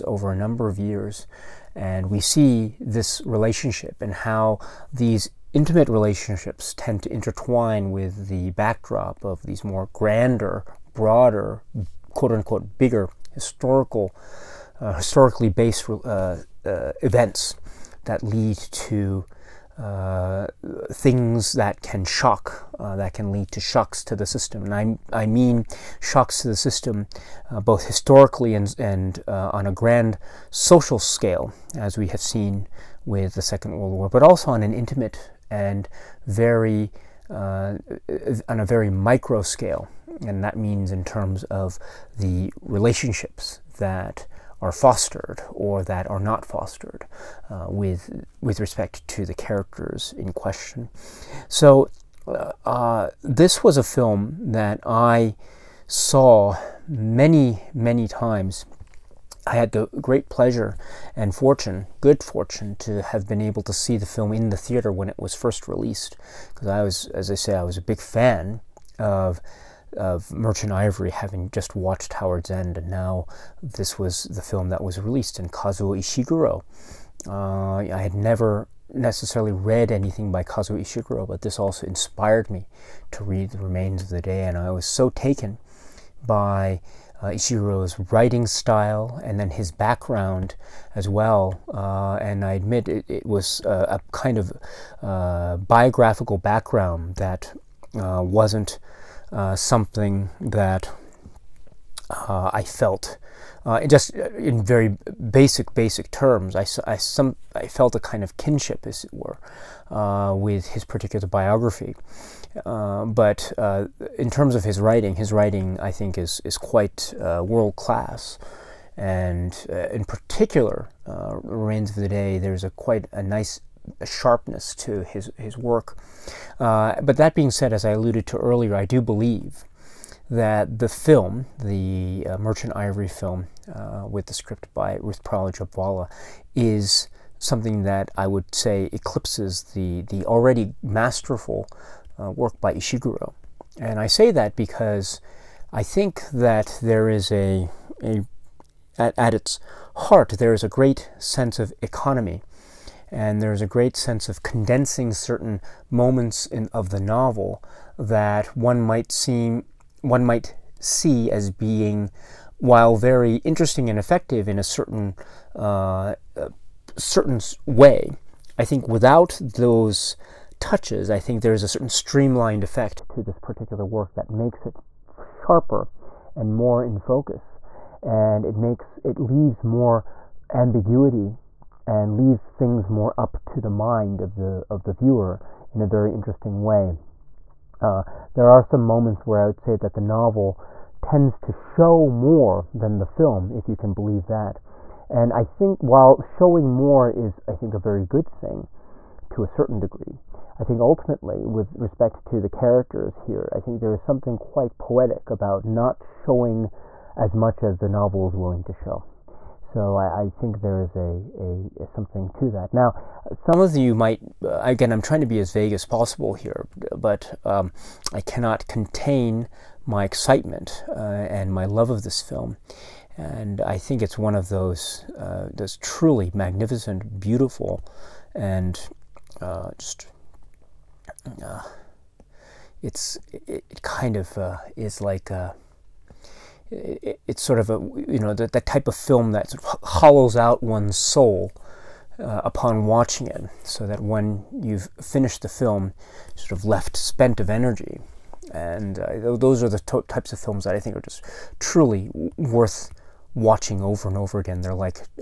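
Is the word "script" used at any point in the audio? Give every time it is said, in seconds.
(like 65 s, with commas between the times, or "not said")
134 s.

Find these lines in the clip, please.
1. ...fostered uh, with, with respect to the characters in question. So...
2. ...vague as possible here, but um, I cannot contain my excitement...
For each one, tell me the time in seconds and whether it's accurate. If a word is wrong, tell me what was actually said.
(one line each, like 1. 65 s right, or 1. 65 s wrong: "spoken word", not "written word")
1. 46 s right
2. 215 s right.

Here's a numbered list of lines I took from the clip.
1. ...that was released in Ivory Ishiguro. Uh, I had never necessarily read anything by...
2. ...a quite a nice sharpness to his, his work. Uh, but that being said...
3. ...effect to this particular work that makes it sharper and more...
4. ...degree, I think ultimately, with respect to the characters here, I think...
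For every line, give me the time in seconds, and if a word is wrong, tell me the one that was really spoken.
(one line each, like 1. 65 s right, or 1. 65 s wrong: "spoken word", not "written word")
1. 74 s wrong: "Kazuo", not "Ivory"
2. 122 s right
3. 172 s right
4. 199 s right.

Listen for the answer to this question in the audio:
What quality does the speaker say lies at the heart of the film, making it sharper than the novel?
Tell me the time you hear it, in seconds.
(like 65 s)
151 s.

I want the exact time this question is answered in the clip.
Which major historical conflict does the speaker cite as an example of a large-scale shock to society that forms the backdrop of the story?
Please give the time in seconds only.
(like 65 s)
33 s.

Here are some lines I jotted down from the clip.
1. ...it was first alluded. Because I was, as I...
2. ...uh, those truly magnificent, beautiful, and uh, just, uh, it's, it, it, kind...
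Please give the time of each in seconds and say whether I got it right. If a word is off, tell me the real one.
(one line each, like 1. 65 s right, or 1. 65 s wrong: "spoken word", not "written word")
1. 65 s wrong: "released", not "alluded"
2. 225 s right.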